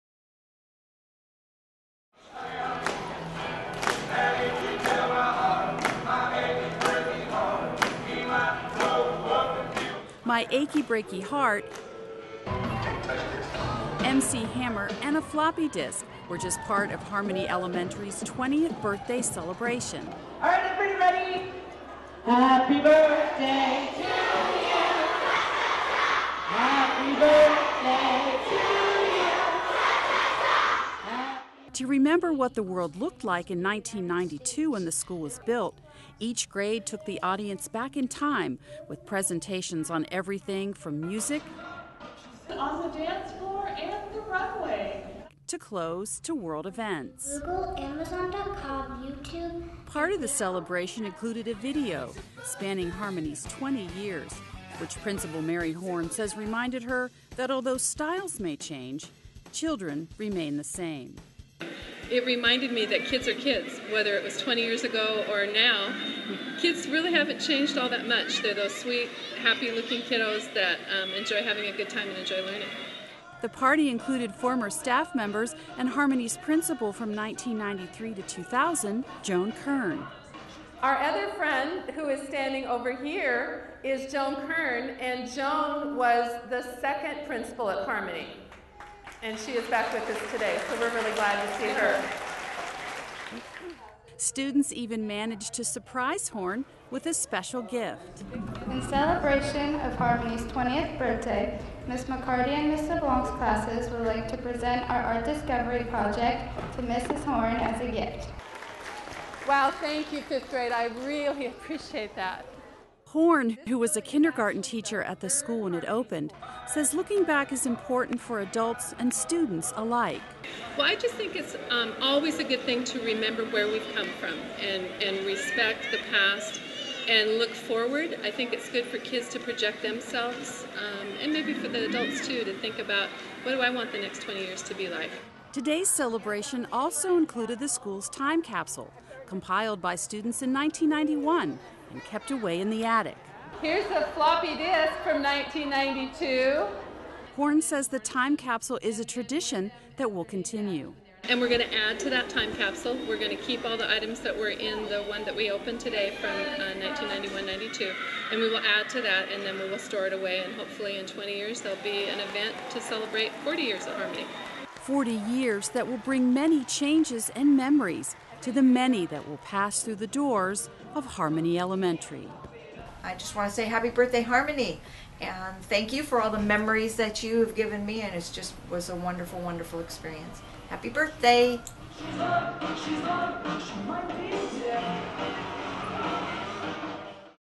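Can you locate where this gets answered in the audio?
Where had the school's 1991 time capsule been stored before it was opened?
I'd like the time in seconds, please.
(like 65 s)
142 s.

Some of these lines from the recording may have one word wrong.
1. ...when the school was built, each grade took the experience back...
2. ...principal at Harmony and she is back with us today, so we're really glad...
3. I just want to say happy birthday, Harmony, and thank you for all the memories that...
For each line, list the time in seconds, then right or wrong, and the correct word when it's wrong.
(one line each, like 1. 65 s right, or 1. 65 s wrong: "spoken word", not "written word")
1. 34 s wrong: "audience", not "experience"
2. 87 s right
3. 173 s right.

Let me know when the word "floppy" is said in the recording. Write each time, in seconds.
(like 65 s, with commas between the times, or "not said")
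15 s, 144 s.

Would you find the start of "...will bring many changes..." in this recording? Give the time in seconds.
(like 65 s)
165 s.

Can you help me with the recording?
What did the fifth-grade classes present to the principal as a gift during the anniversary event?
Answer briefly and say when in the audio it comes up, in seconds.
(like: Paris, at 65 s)
art discovery project, at 105 s.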